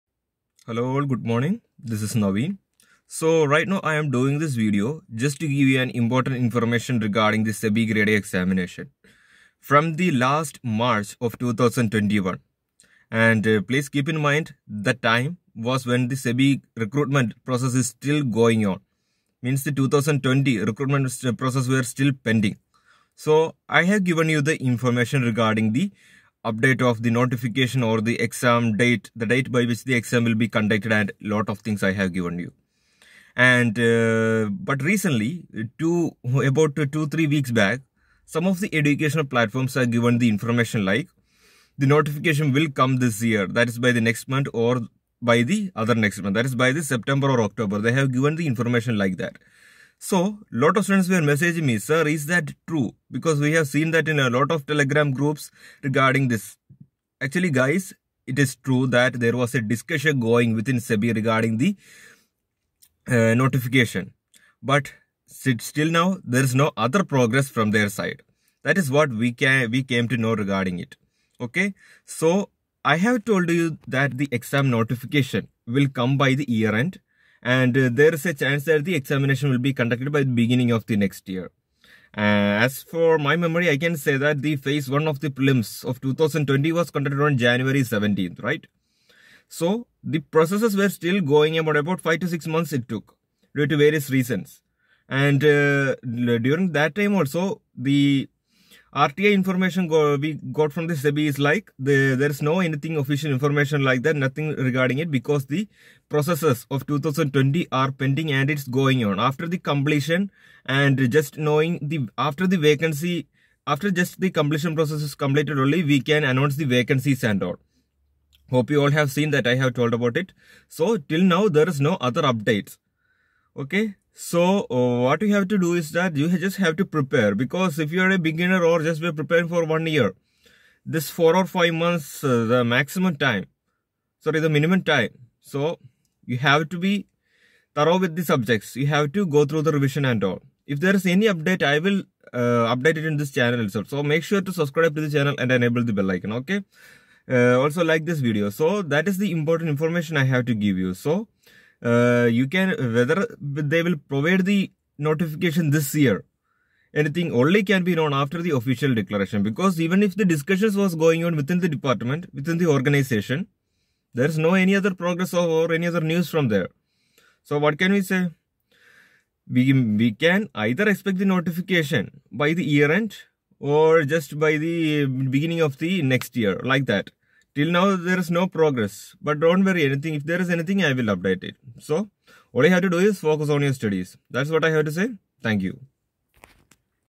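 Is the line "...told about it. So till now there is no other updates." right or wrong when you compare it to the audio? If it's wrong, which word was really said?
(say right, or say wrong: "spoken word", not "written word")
right.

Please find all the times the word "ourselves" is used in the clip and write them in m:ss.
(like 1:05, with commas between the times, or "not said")
not said.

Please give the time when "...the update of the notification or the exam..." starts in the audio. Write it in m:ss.
0:25.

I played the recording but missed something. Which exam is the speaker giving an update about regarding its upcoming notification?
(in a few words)
SEBI Grade A.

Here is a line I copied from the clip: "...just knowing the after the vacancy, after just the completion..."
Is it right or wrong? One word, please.
right.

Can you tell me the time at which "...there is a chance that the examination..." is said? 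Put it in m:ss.
1:17.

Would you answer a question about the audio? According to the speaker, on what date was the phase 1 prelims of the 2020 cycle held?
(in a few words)
January 17.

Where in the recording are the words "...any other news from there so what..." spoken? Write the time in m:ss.
2:45.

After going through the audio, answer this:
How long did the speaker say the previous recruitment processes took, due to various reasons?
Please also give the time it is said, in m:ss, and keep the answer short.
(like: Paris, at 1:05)
5 to 6 months, at 1:32.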